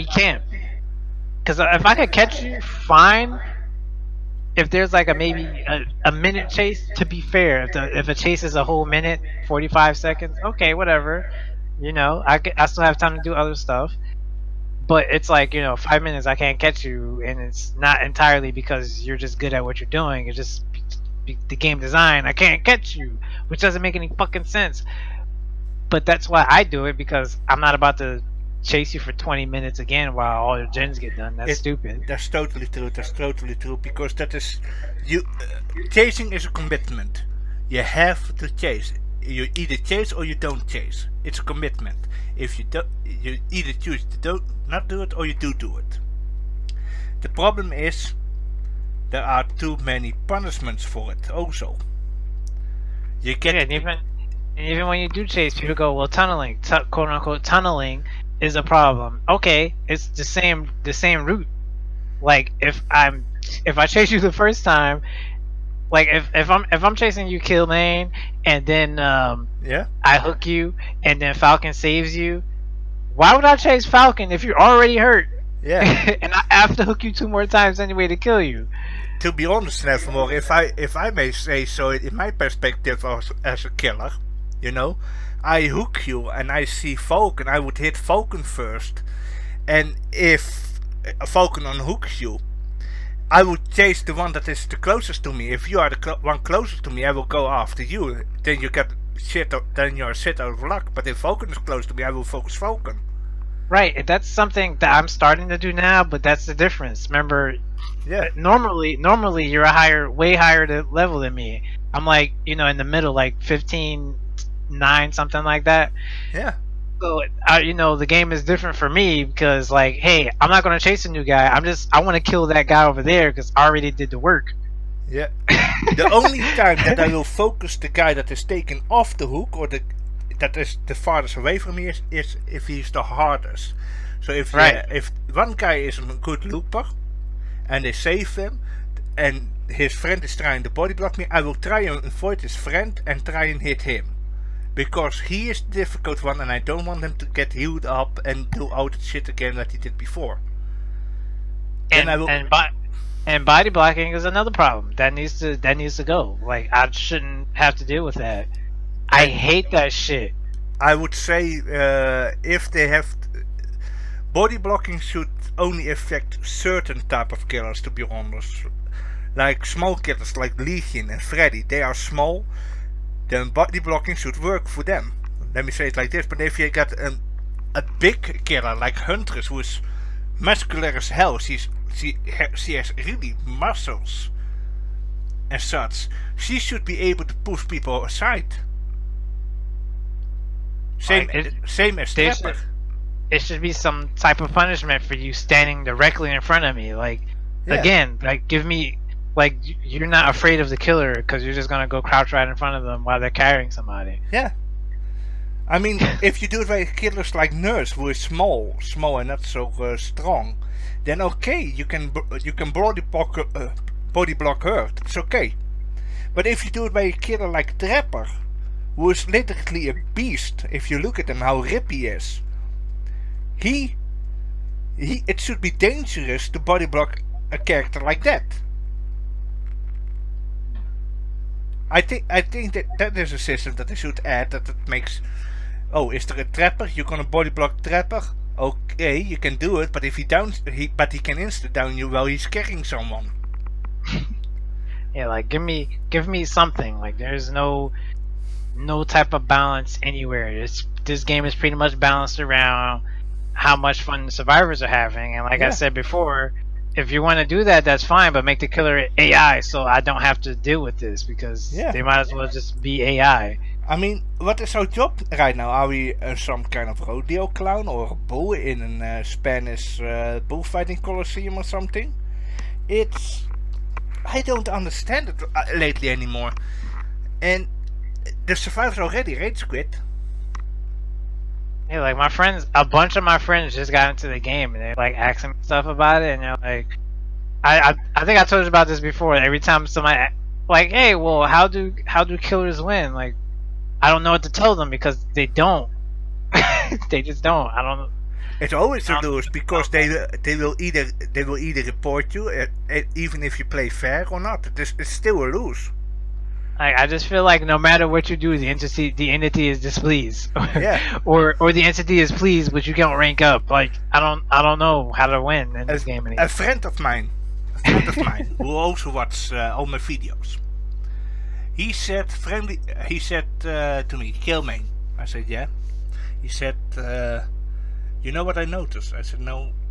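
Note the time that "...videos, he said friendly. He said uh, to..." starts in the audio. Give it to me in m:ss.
5:19.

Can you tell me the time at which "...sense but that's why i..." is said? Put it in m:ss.
0:24.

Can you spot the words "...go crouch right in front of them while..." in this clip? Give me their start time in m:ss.
3:21.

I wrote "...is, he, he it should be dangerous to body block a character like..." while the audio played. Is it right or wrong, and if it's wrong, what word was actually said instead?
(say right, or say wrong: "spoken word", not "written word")
right.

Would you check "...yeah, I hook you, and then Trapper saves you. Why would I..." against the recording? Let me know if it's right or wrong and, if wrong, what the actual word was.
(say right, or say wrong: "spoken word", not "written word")
wrong: "Falcon", not "Trapper".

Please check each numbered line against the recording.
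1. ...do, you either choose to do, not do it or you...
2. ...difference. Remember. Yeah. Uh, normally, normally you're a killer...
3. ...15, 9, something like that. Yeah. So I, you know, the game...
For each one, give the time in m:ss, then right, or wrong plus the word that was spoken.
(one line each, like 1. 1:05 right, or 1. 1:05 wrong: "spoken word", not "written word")
1. 0:42 right
2. 1:46 wrong: "higher", not "killer"
3. 1:53 right.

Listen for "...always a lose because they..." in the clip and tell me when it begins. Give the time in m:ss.
4:58.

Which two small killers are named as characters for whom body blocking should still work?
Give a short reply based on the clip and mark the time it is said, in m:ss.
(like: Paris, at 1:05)
Legion and Freddy, at 2:50.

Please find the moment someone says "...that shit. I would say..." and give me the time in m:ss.
2:39.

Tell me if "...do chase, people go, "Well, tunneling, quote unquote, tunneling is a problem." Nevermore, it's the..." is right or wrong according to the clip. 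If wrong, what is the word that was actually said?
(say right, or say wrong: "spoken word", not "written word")
wrong: "Okay", not "Nevermore".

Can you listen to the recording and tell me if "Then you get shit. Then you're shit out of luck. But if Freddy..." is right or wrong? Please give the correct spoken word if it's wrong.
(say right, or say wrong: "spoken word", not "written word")
wrong: "Falcon", not "Freddy".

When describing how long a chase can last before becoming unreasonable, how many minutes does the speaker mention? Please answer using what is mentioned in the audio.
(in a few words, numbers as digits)
5.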